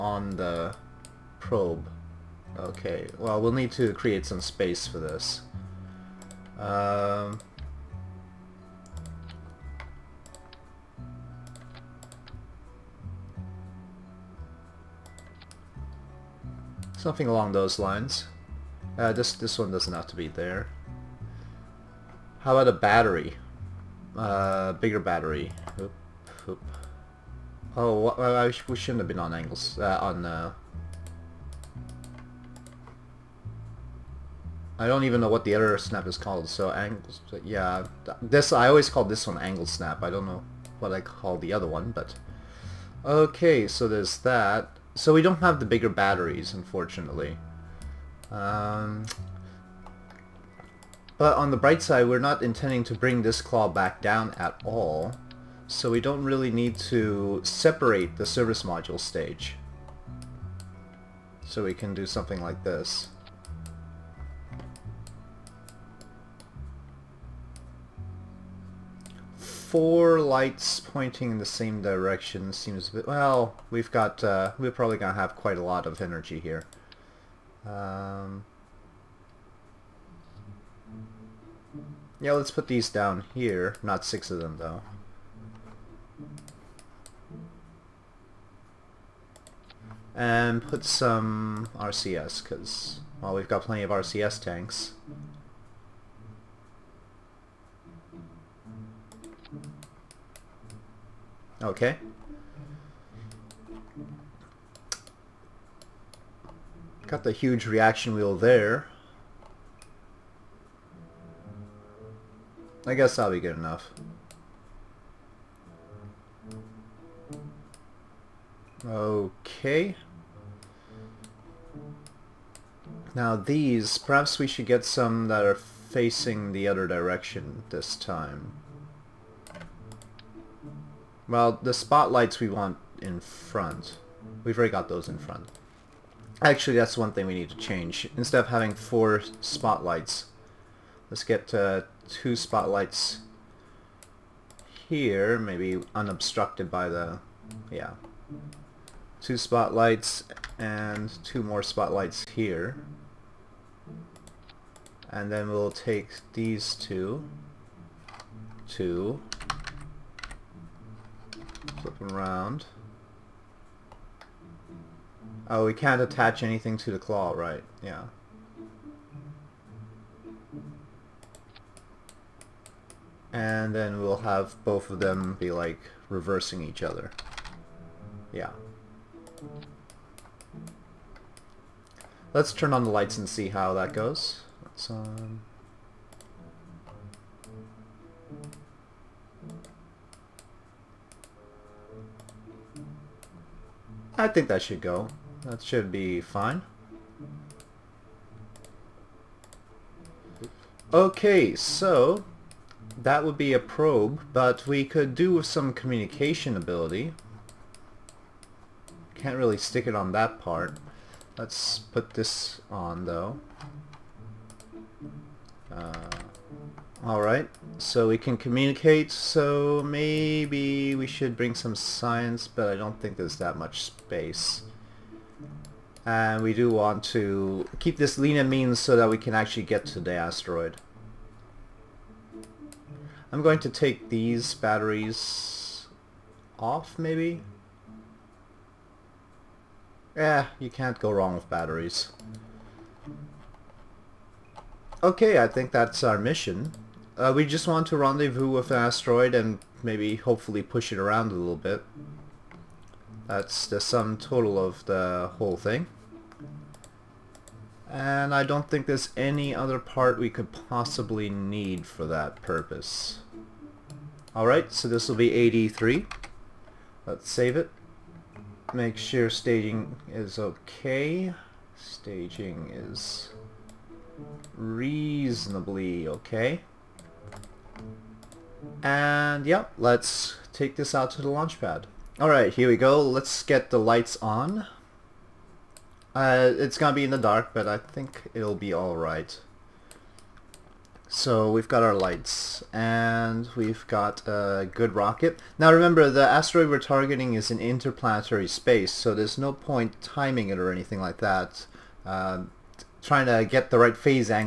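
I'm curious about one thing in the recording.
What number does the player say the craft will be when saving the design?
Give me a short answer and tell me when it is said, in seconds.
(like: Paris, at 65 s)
83, at 265 s.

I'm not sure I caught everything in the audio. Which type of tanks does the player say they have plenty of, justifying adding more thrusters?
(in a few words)
RCS tanks.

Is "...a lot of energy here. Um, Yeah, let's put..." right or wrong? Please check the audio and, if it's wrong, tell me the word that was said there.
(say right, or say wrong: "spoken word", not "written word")
right.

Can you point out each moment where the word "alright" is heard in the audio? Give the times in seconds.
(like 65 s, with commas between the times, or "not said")
217 s, 264 s, 282 s, 288 s.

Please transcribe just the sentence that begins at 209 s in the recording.
Can't really stick it on that part.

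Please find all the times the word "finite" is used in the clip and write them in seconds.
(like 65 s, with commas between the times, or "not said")
not said.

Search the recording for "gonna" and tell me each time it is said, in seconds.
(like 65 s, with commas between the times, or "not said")
286 s.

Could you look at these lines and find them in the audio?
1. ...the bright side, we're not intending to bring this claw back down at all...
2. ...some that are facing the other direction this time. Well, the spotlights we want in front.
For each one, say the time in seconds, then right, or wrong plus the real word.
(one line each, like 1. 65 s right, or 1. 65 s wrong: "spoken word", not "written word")
1. 51 s right
2. 124 s right.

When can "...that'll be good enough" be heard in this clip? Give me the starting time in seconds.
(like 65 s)
113 s.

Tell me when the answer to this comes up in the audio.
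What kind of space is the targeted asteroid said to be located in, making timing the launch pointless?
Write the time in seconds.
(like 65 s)
297 s.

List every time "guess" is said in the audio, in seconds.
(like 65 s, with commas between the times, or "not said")
112 s.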